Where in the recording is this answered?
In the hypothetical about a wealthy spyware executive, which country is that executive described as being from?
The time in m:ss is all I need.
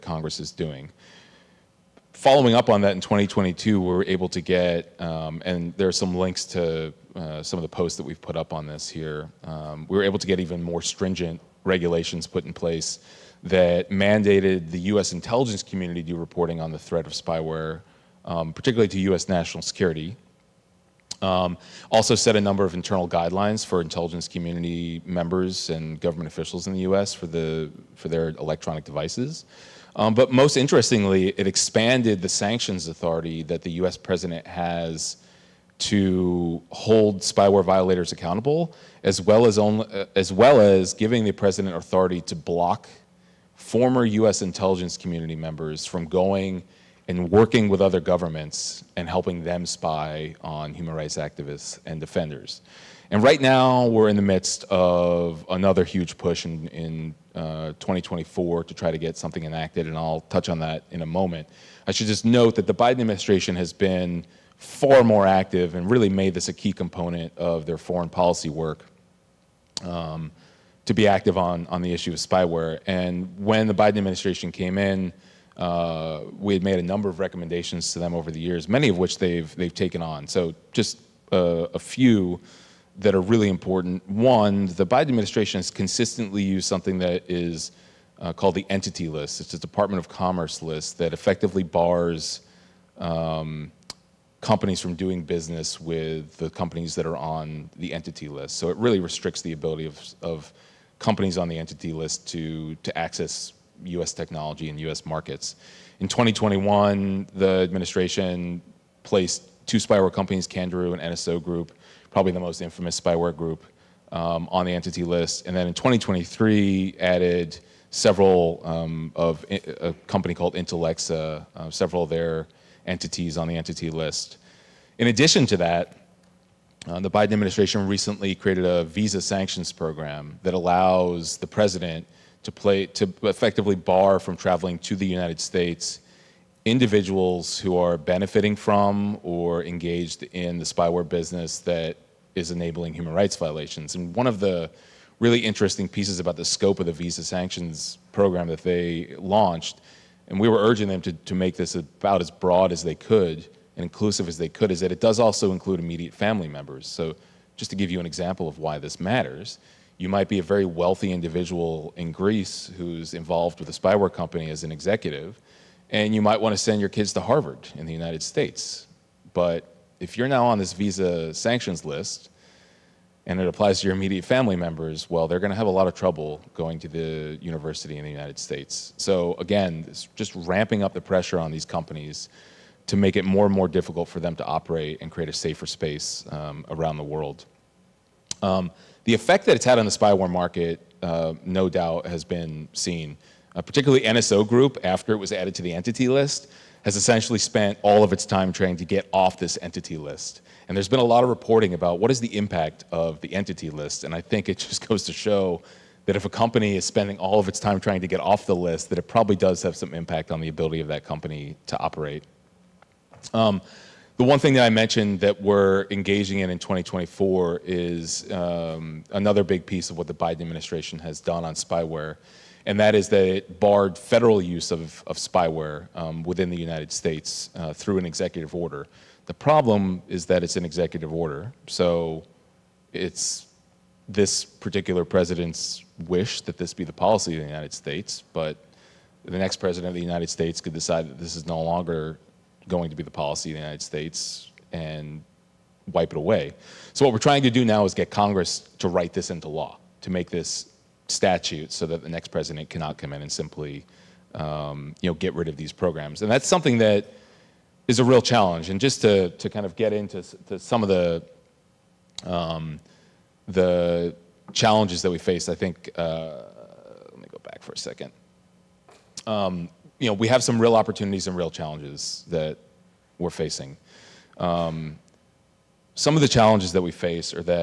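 2:42.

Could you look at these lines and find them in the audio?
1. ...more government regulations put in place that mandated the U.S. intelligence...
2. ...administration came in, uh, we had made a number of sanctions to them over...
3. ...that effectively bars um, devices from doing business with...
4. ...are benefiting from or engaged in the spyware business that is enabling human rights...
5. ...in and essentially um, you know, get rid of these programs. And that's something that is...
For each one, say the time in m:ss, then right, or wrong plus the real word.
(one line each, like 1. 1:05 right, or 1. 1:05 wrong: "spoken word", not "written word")
1. 0:10 wrong: "stringent", not "government"
2. 1:13 wrong: "recommendations", not "sanctions"
3. 1:30 wrong: "companies", not "devices"
4. 2:17 right
5. 4:13 wrong: "simply", not "essentially".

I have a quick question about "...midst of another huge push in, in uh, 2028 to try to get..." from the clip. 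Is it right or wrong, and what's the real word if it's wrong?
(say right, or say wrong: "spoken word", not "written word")
wrong: "2024", not "2028".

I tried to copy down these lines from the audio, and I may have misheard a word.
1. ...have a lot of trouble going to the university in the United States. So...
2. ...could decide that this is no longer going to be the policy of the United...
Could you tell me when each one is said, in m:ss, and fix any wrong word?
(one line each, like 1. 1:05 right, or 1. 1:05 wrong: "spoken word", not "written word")
1. 2:55 right
2. 4:00 right.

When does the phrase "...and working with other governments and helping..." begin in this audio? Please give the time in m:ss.
0:47.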